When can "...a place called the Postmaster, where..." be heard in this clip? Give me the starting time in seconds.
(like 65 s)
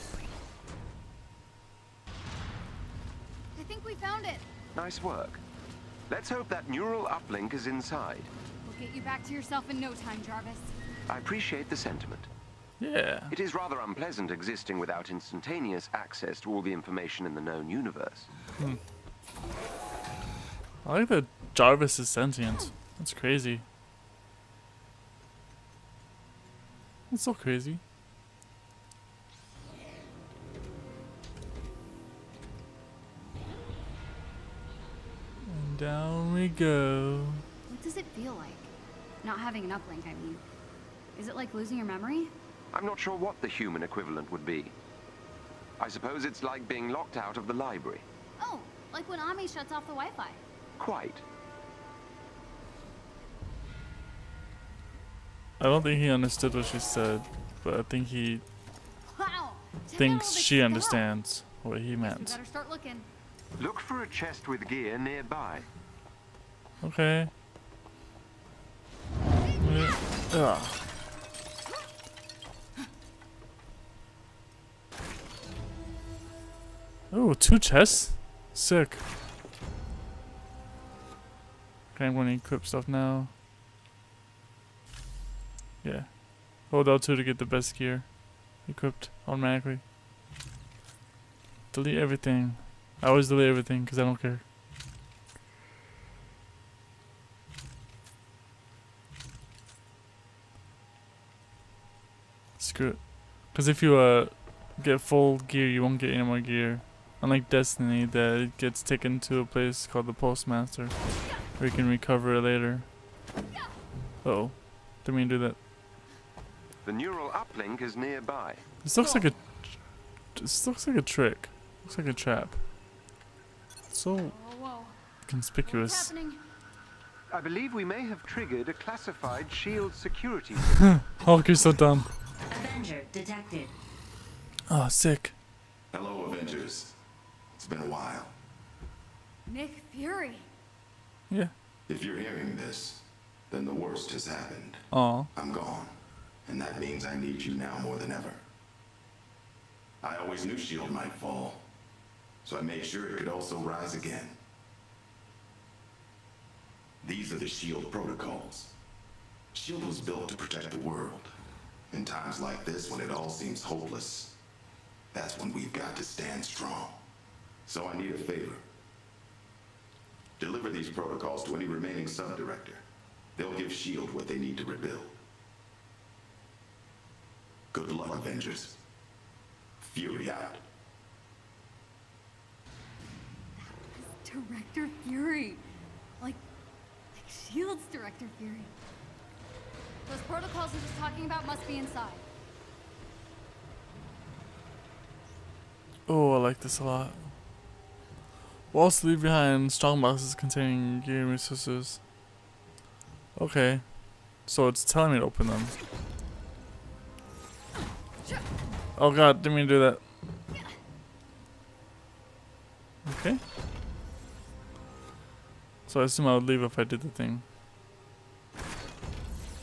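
109 s.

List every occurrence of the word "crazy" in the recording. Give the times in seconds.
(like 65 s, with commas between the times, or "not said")
23 s, 27 s.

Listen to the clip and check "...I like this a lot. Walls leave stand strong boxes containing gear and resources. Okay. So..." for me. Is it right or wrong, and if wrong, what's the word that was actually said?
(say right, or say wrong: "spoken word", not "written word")
wrong: "behind", not "stand".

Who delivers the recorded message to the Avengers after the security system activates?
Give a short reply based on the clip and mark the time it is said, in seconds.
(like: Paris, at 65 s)
Nick Fury, at 139 s.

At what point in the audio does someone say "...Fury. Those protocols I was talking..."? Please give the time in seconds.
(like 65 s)
188 s.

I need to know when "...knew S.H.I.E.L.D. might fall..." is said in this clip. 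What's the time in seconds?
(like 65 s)
150 s.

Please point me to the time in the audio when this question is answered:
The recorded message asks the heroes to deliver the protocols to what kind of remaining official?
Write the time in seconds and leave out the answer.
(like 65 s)
172 s.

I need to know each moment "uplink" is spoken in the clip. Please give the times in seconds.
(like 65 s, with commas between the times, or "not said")
7 s, 39 s, 117 s.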